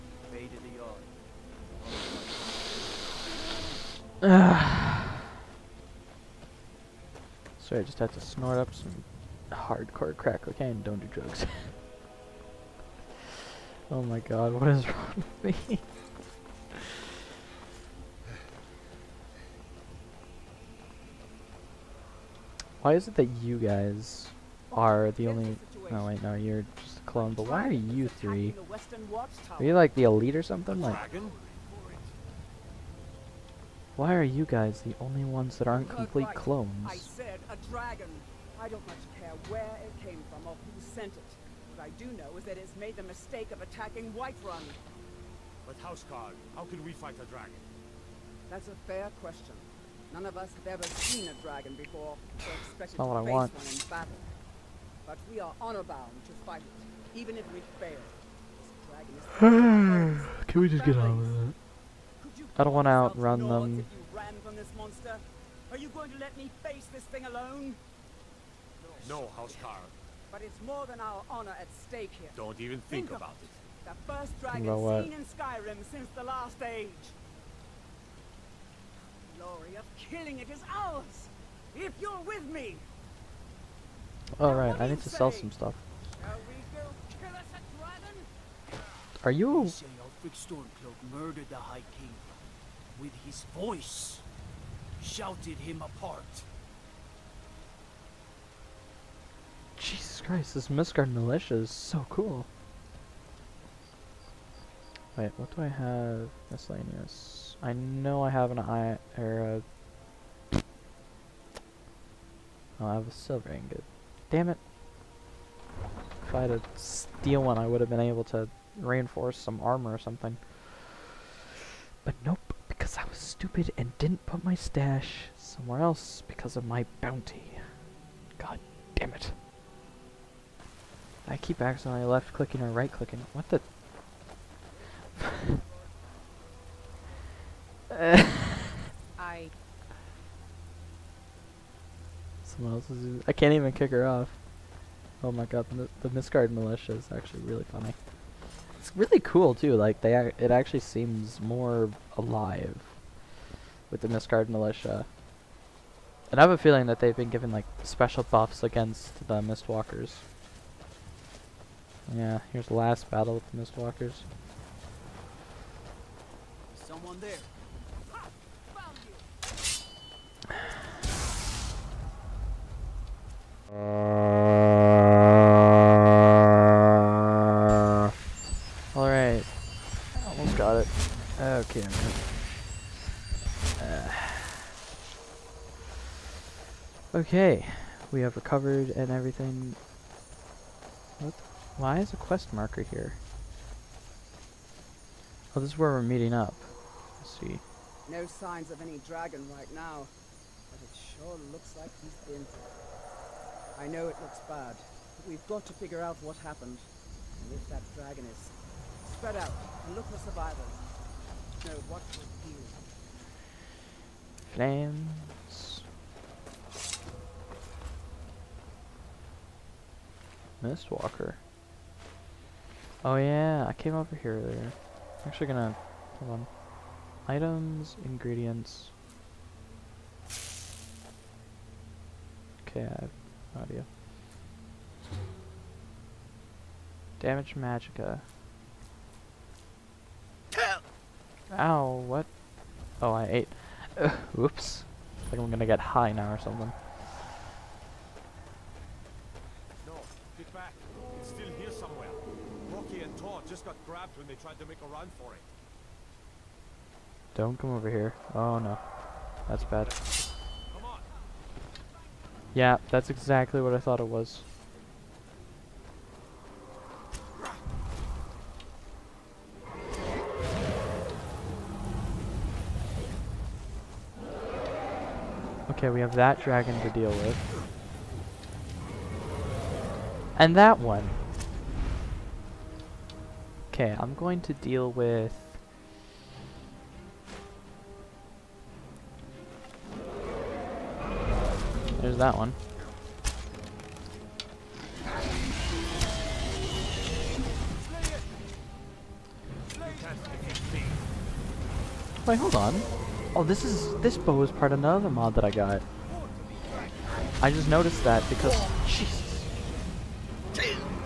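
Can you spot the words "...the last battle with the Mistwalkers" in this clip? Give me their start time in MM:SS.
02:42.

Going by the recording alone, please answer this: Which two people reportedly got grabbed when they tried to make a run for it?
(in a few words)
Hroki and Tor.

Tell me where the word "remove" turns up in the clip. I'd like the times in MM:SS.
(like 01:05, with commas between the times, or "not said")
not said.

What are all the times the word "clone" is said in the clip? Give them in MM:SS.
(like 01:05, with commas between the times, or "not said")
00:27, 00:36.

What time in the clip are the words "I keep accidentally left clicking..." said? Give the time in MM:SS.
02:11.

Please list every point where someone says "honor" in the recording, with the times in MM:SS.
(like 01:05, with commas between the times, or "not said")
00:55, 01:11.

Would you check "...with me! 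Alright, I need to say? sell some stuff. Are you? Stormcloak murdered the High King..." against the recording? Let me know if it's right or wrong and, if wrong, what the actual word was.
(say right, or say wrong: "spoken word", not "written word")
right.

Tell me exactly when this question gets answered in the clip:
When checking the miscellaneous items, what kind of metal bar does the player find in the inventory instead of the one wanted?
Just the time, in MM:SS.
01:53.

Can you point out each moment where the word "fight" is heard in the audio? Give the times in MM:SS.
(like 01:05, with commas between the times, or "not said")
00:46, 00:56.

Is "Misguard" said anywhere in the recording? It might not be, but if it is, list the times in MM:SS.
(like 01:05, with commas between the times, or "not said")
02:26, 02:34.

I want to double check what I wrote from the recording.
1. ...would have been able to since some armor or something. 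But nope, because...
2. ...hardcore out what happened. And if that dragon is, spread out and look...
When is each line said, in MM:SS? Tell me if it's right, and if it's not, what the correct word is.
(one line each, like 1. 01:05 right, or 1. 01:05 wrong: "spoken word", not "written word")
1. 01:57 wrong: "reinforce", not "since"
2. 03:25 wrong: "figure", not "hardcore".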